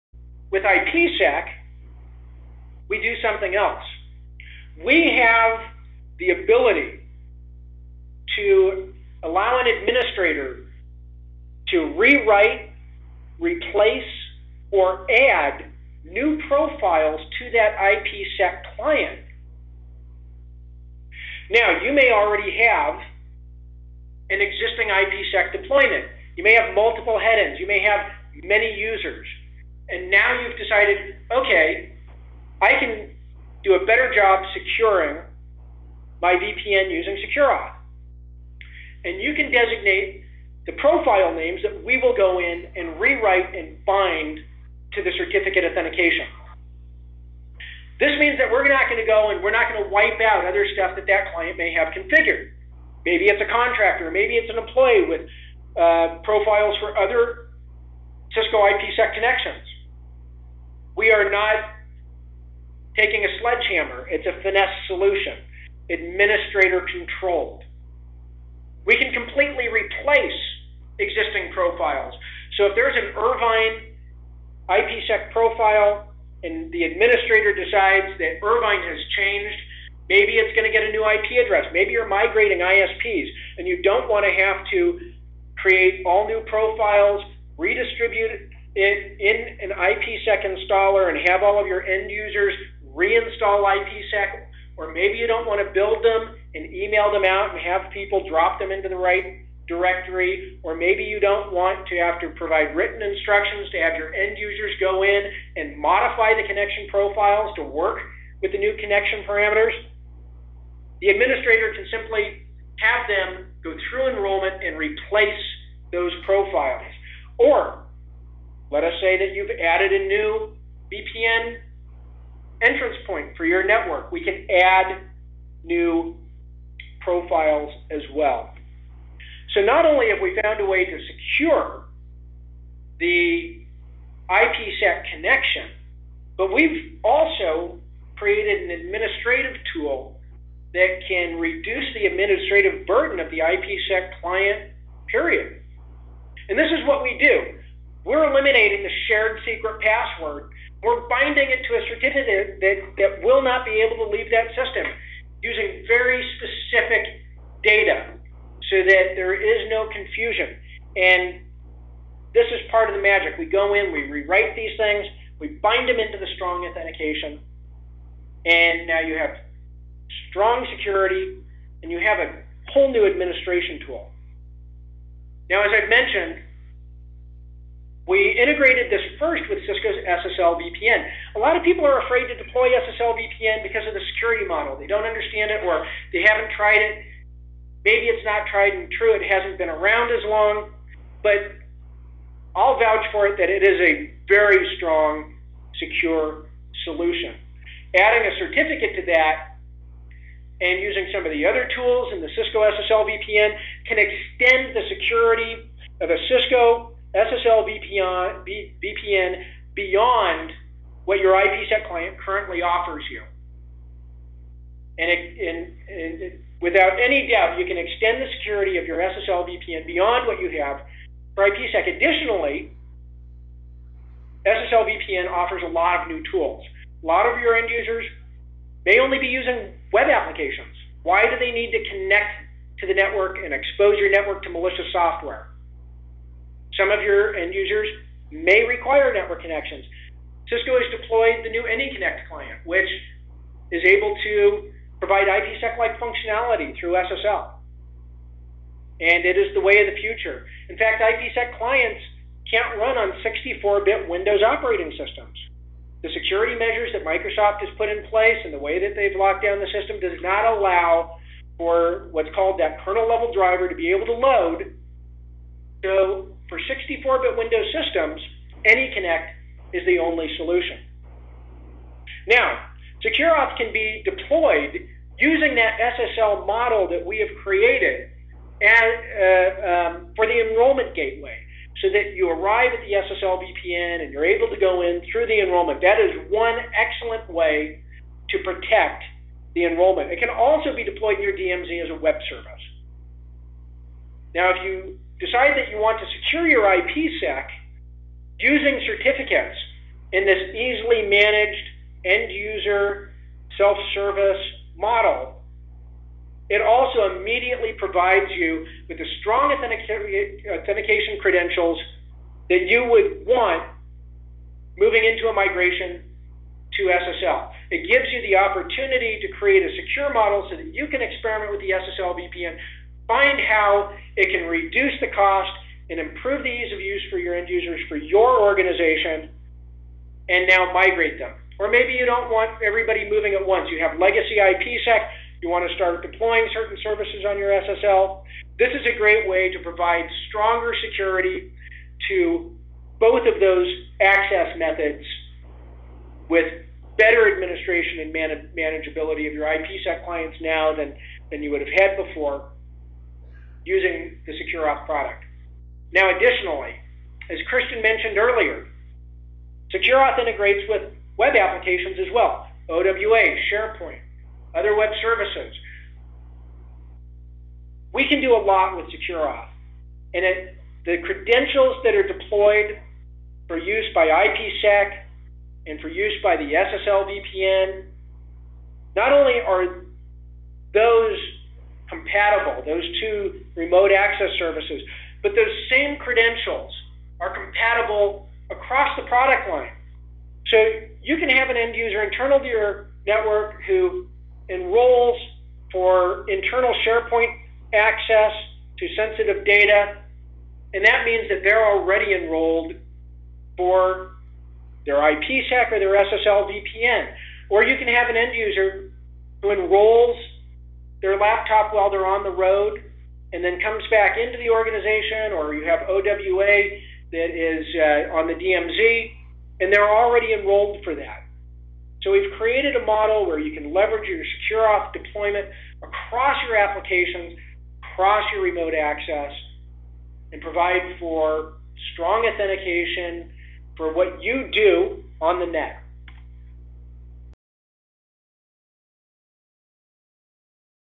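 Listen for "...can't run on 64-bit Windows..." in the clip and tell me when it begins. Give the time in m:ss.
4:12.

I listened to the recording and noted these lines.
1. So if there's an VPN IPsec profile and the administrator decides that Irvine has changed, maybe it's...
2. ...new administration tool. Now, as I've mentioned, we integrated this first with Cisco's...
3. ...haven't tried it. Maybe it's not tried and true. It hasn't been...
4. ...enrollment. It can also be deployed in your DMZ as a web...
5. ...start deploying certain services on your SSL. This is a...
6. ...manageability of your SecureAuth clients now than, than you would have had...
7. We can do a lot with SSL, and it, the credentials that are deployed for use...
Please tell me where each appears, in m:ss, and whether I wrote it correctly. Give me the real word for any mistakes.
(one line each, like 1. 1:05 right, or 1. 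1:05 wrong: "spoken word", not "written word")
1. 1:12 wrong: "Irvine", not "VPN"
2. 2:52 right
3. 3:06 right
4. 4:49 right
5. 5:35 right
6. 5:48 wrong: "IPsec", not "SecureAuth"
7. 6:07 wrong: "SecureAuth", not "SSL".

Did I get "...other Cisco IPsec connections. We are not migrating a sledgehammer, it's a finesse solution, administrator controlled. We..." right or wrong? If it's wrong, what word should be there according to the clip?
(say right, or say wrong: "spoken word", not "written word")
wrong: "taking", not "migrating".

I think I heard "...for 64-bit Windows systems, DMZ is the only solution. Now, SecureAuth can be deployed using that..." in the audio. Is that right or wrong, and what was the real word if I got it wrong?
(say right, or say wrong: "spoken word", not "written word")
wrong: "AnyConnect", not "DMZ".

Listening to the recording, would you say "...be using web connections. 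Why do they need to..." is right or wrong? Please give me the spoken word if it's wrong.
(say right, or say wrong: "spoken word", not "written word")
wrong: "applications", not "connections".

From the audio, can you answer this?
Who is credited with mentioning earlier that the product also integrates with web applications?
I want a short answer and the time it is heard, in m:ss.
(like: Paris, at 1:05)
Christian, at 5:57.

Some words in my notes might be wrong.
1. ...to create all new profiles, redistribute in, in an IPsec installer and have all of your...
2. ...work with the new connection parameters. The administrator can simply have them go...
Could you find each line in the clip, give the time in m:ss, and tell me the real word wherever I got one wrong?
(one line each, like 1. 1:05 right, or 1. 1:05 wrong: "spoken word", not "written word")
1. 1:24 right
2. 1:47 right.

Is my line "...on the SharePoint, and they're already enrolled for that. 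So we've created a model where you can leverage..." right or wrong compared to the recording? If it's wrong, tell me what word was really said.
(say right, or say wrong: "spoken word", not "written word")
wrong: "DMZ", not "SharePoint".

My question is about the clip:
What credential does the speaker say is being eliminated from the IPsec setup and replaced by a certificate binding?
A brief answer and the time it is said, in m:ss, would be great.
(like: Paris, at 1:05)
Shared secret password, at 2:29.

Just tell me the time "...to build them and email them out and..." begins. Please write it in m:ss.
1:35.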